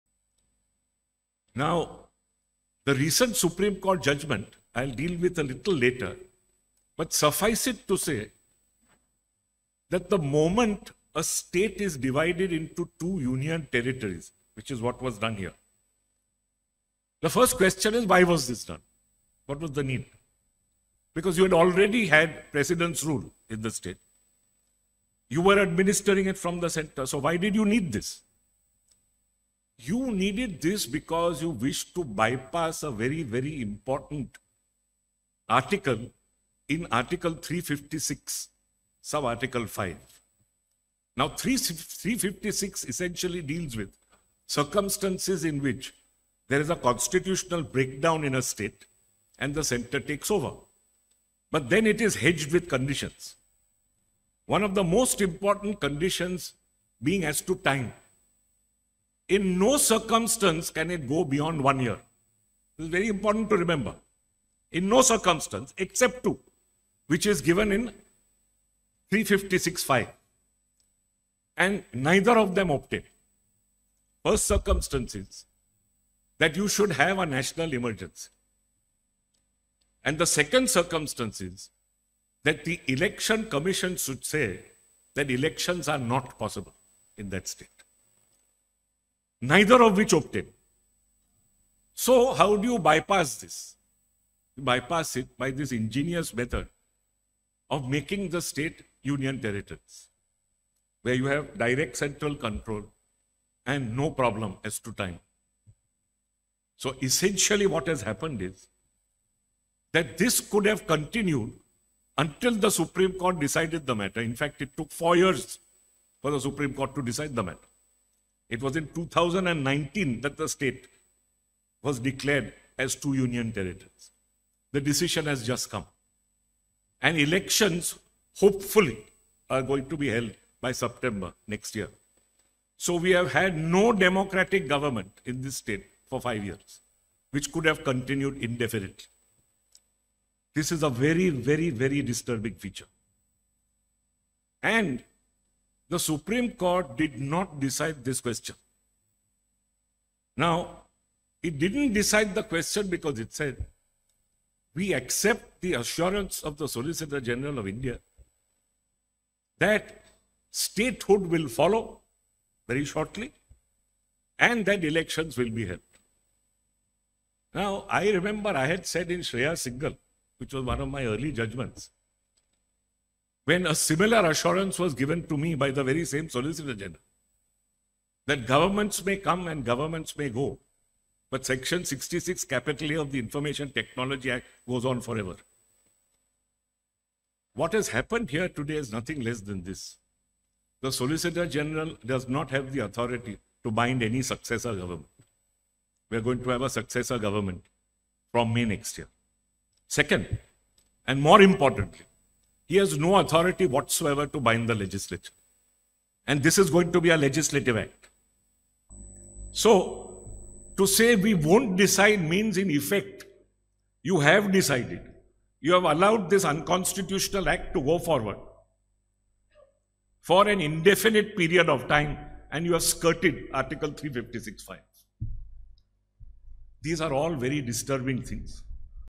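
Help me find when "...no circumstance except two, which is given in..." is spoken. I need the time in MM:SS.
01:04.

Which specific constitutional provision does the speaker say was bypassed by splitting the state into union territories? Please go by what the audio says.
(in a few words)
Article 356(5).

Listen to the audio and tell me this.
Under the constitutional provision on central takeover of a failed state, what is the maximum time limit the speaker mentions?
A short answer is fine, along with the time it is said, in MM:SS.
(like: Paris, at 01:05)
one year, at 01:01.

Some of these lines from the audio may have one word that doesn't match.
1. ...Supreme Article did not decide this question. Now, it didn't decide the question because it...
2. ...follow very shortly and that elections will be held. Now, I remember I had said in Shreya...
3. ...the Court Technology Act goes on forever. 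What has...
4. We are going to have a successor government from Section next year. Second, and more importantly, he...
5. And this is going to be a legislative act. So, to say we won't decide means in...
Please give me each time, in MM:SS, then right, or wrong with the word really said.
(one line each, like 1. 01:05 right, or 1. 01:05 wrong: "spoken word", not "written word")
1. 02:25 wrong: "Court", not "Article"
2. 02:41 right
3. 03:03 wrong: "Information", not "Court"
4. 03:16 wrong: "May", not "Section"
5. 03:26 right.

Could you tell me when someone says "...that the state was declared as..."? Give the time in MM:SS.
02:00.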